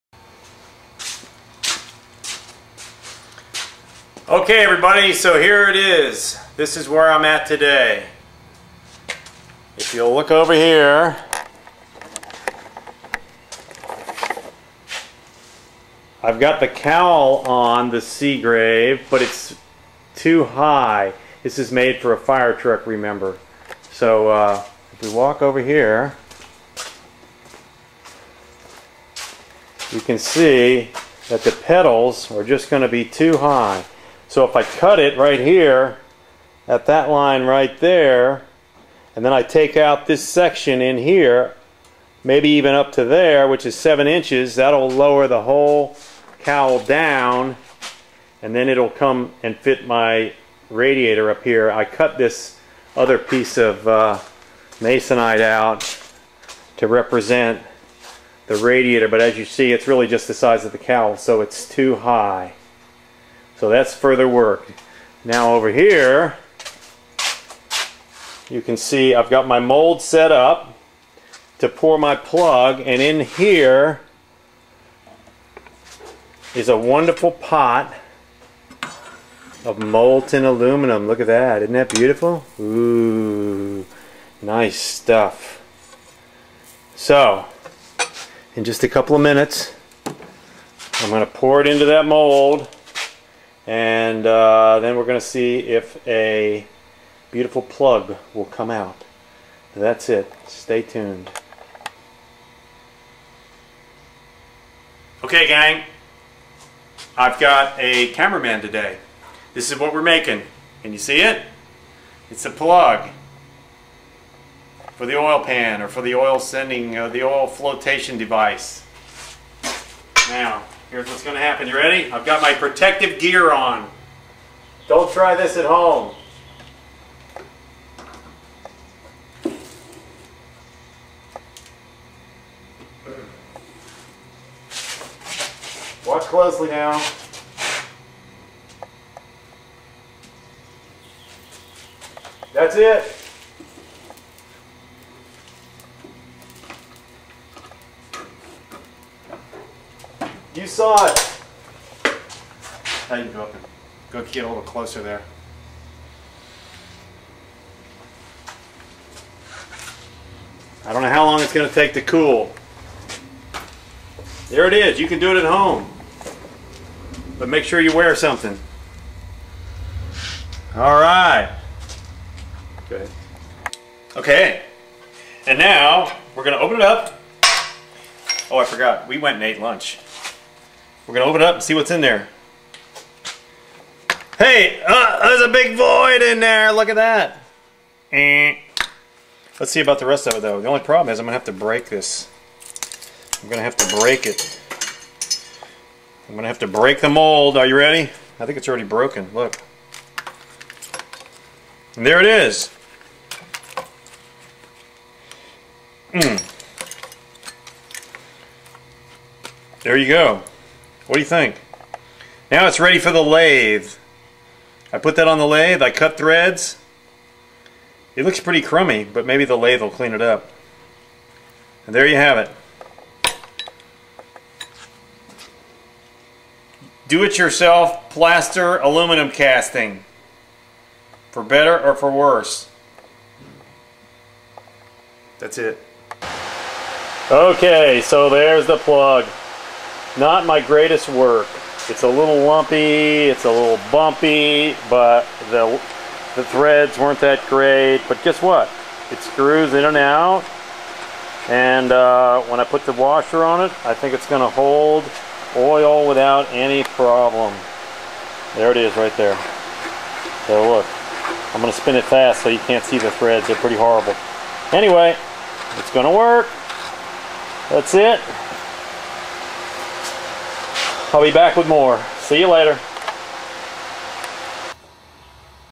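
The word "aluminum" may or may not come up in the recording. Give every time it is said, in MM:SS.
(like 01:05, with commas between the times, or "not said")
01:20, 03:48.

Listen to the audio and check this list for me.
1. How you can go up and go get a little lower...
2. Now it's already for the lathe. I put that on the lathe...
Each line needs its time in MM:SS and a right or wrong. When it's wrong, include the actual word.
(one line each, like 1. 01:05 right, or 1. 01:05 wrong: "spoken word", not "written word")
1. 02:33 wrong: "closer", not "lower"
2. 03:32 wrong: "ready", not "already".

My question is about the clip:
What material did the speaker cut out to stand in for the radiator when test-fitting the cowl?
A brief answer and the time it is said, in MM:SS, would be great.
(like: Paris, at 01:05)
Masonite, at 00:54.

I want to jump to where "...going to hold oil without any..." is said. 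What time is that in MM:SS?
04:14.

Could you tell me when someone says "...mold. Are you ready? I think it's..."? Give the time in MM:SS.
03:17.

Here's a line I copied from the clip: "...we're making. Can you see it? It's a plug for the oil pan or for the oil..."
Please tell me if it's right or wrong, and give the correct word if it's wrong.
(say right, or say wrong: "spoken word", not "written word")
right.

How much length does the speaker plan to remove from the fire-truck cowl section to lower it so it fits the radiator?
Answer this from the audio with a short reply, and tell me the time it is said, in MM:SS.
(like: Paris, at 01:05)
7 inches, at 00:43.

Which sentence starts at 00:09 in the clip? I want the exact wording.
If you'll look over here, I've got the cowl on the Seagrave, but it's too high.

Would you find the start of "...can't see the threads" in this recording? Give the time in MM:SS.
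04:22.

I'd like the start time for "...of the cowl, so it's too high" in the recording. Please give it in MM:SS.
01:00.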